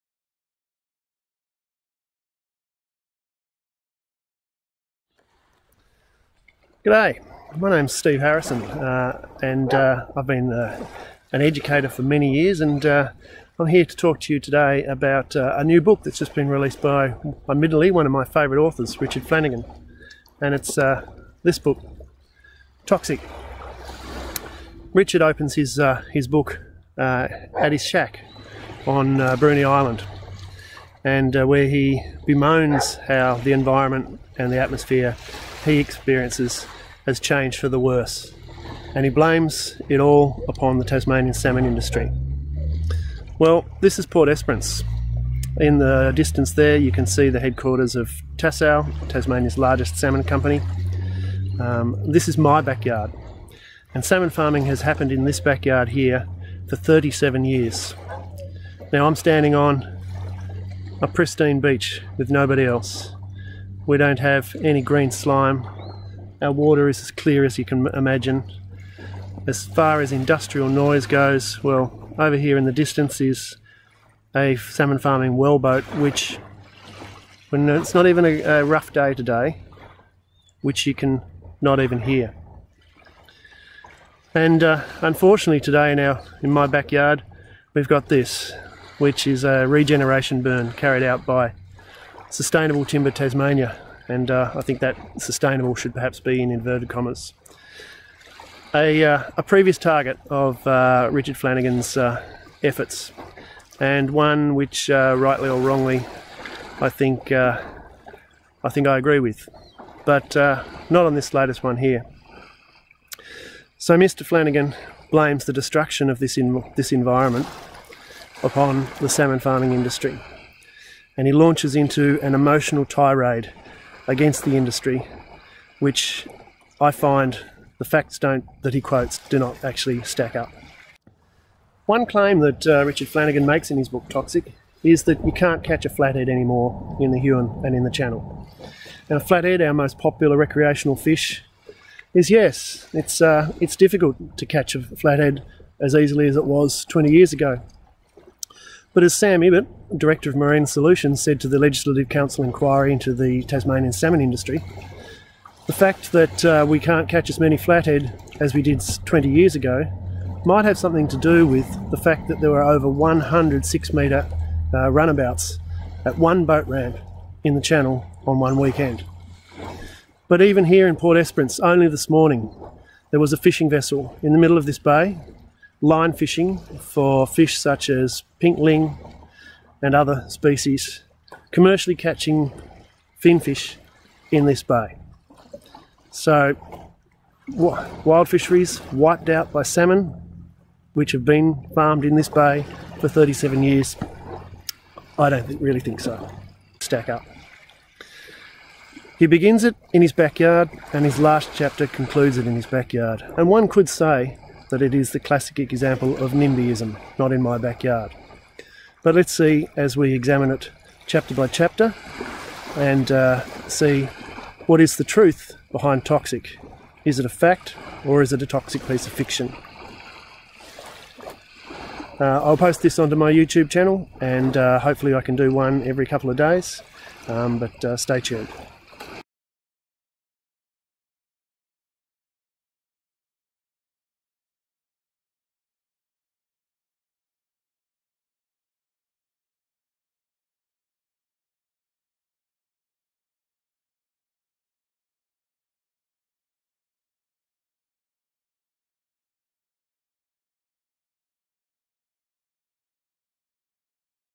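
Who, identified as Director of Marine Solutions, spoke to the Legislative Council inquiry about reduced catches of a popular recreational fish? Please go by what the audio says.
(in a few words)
Sam Ibbott.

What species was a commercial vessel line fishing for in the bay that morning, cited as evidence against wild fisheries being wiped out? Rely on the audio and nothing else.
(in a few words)
pink ling.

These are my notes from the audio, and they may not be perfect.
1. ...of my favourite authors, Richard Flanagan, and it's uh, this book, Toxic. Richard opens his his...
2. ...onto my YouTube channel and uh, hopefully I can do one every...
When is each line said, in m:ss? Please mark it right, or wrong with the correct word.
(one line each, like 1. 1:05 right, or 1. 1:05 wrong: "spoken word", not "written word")
1. 0:18 right
2. 3:42 right.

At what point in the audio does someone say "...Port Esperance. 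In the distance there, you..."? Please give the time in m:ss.
0:44.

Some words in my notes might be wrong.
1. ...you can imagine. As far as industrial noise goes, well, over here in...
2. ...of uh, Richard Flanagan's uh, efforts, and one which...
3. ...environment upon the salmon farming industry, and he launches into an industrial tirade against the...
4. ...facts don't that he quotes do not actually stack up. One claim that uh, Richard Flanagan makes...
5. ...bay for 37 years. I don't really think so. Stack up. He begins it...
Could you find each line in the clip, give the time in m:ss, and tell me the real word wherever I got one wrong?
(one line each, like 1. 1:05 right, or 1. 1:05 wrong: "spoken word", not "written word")
1. 1:07 right
2. 1:40 right
3. 1:56 wrong: "emotional", not "industrial"
4. 2:07 right
5. 3:12 right.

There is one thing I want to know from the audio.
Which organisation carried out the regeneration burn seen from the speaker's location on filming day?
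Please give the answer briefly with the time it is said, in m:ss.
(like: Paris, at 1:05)
Sustainable Timber Tasmania, at 1:32.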